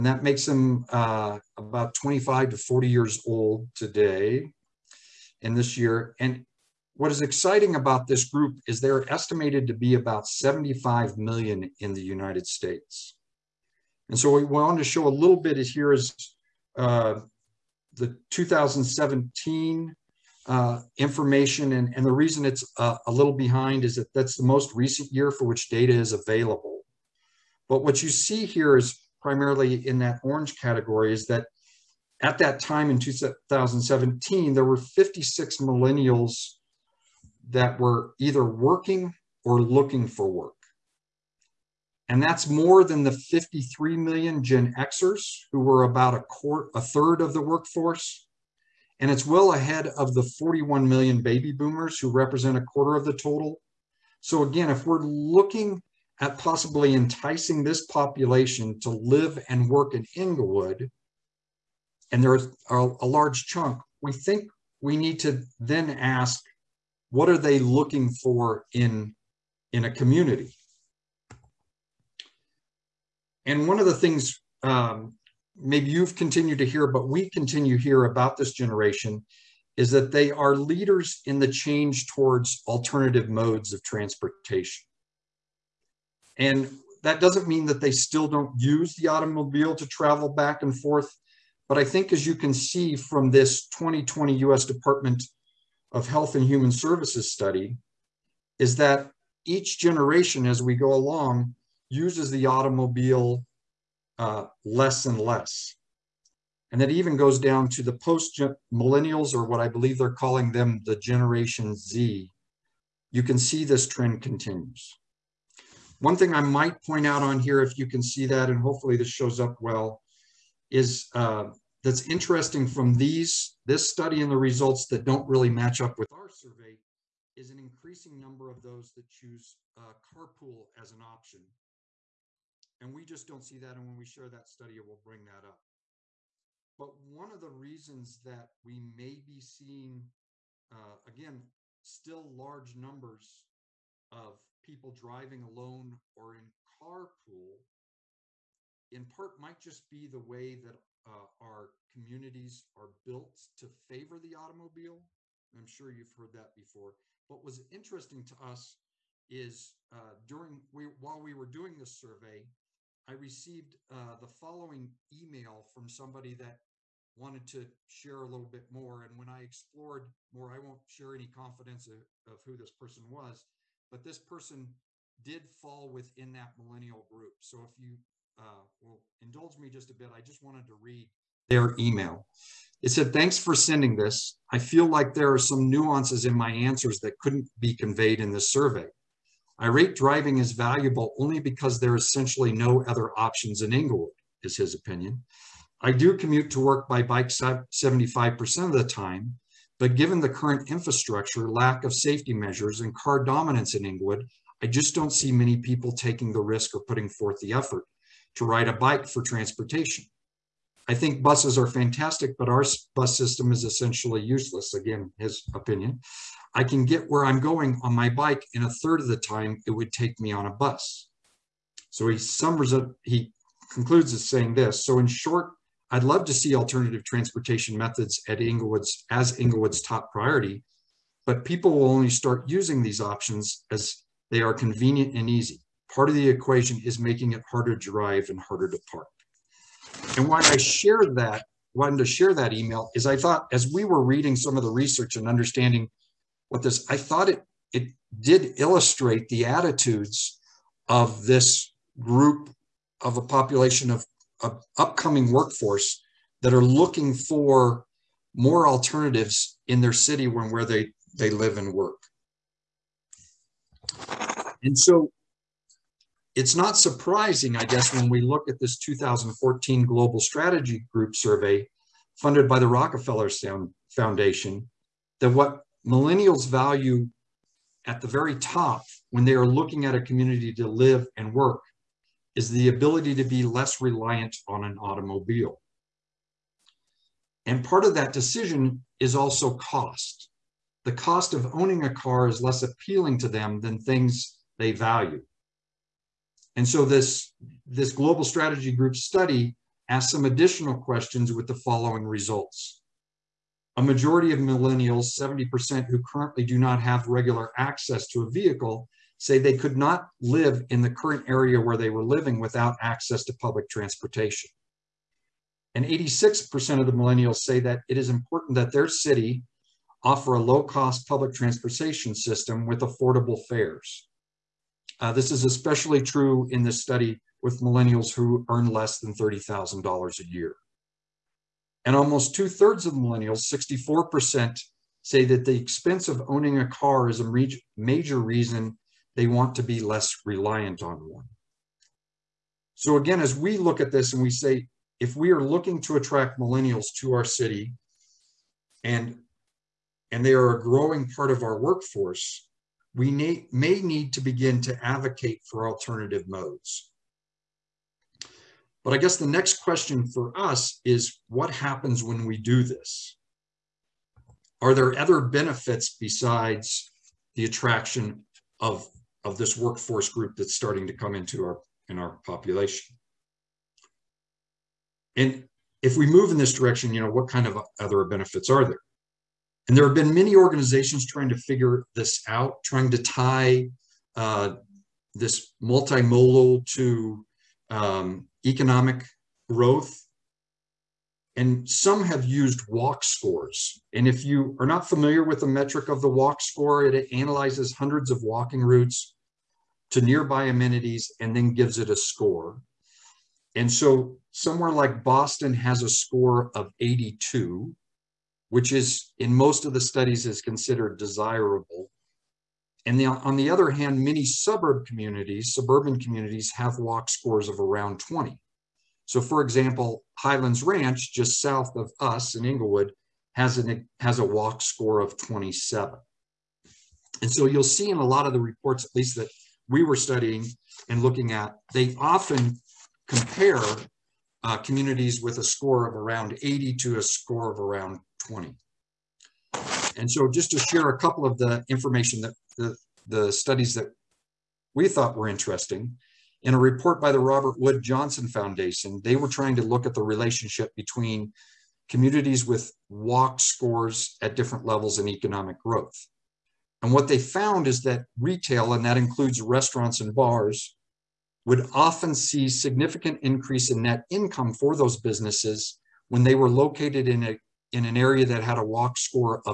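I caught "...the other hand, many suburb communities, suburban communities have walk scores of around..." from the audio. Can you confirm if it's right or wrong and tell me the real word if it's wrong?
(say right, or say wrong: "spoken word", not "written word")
right.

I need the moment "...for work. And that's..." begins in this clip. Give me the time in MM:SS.
00:40.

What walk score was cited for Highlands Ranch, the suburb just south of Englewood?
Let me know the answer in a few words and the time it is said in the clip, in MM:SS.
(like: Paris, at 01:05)
27, at 07:05.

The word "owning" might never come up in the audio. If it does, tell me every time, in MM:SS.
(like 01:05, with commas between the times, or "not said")
04:51, 05:36.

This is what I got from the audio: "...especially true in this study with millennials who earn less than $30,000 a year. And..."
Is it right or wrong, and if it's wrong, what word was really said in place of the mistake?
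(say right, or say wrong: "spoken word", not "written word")
right.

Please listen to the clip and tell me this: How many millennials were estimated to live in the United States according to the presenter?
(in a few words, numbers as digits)
75 million.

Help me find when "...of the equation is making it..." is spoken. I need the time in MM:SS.
03:56.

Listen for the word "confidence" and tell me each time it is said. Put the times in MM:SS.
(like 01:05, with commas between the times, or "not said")
02:51.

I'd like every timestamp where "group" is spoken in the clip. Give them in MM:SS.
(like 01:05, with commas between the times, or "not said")
00:08, 02:57, 04:11, 04:30, 04:58, 06:10.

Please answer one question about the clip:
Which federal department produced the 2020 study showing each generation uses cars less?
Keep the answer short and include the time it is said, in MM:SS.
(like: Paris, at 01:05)
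US Department of Health and Human Services, at 01:34.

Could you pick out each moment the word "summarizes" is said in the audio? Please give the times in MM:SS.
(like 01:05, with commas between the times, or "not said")
03:42.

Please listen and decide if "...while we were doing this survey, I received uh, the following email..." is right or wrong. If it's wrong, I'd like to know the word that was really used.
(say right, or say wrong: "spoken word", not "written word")
right.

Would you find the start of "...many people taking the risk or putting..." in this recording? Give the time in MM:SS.
03:25.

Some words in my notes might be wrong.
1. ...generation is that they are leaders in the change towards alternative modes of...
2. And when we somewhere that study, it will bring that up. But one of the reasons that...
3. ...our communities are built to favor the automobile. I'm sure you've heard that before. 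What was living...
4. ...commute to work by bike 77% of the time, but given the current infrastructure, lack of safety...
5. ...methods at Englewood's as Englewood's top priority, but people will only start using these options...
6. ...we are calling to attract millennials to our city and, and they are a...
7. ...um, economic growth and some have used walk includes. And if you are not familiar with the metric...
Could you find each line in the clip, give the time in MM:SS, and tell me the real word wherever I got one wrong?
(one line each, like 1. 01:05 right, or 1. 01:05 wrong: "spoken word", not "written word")
1. 01:18 right
2. 02:13 wrong: "share", not "somewhere"
3. 02:31 wrong: "interesting", not "living"
4. 03:16 wrong: "75", not "77"
5. 03:47 right
6. 05:45 wrong: "looking", not "calling"
7. 06:27 wrong: "scores", not "includes".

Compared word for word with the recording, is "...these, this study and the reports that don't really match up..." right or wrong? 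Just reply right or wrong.
wrong.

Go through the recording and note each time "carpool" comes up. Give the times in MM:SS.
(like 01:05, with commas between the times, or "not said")
02:09, 02:26.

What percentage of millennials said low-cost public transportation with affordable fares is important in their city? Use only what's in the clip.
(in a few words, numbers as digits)
86%.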